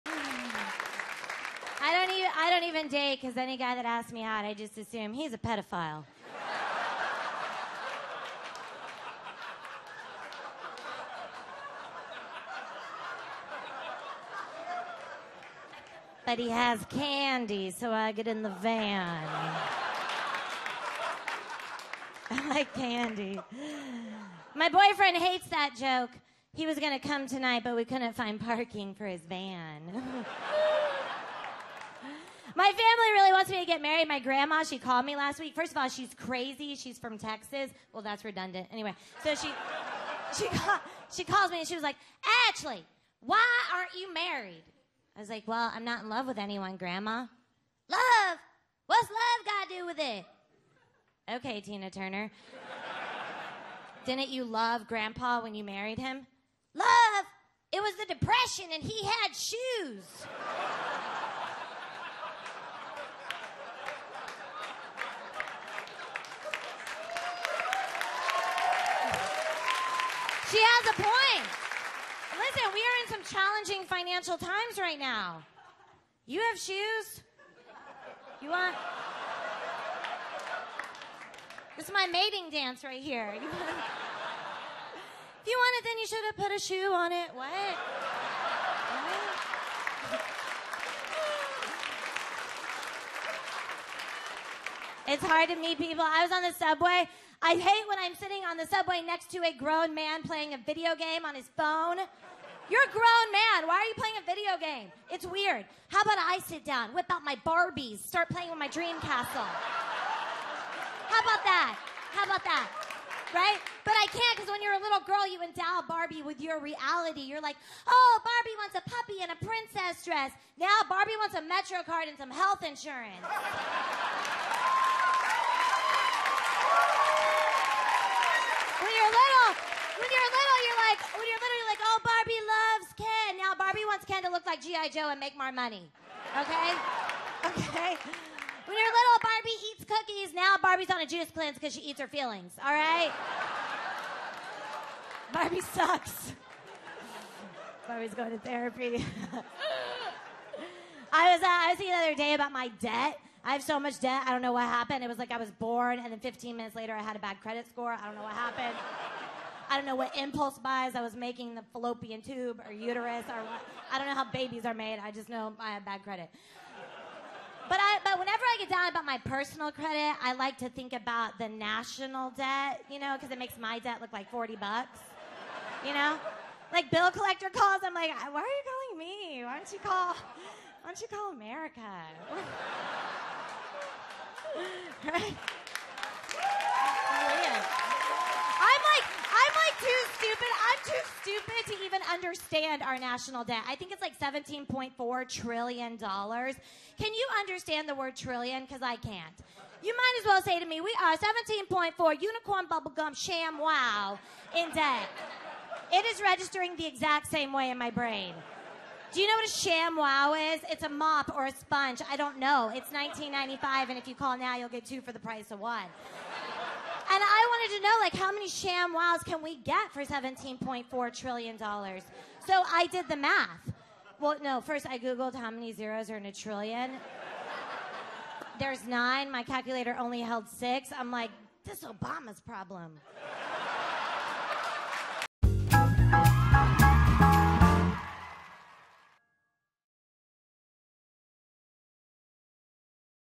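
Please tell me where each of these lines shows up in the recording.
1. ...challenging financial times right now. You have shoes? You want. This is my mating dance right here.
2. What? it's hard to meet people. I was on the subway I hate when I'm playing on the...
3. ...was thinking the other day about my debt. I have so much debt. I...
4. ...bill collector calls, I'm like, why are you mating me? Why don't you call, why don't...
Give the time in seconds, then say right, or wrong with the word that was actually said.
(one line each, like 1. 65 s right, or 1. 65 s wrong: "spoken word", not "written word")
1. 73 s right
2. 87 s wrong: "sitting", not "playing"
3. 151 s right
4. 176 s wrong: "calling", not "mating".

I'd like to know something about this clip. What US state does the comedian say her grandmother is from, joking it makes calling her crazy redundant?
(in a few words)
Texas.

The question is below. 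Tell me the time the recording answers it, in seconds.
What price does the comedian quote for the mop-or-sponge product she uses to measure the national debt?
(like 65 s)
212 s.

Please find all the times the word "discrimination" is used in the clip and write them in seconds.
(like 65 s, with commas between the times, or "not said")
not said.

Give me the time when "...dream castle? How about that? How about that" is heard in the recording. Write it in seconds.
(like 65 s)
108 s.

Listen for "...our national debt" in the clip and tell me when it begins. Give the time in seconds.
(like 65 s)
192 s.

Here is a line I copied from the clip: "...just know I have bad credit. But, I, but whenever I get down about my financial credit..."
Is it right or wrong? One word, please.
wrong.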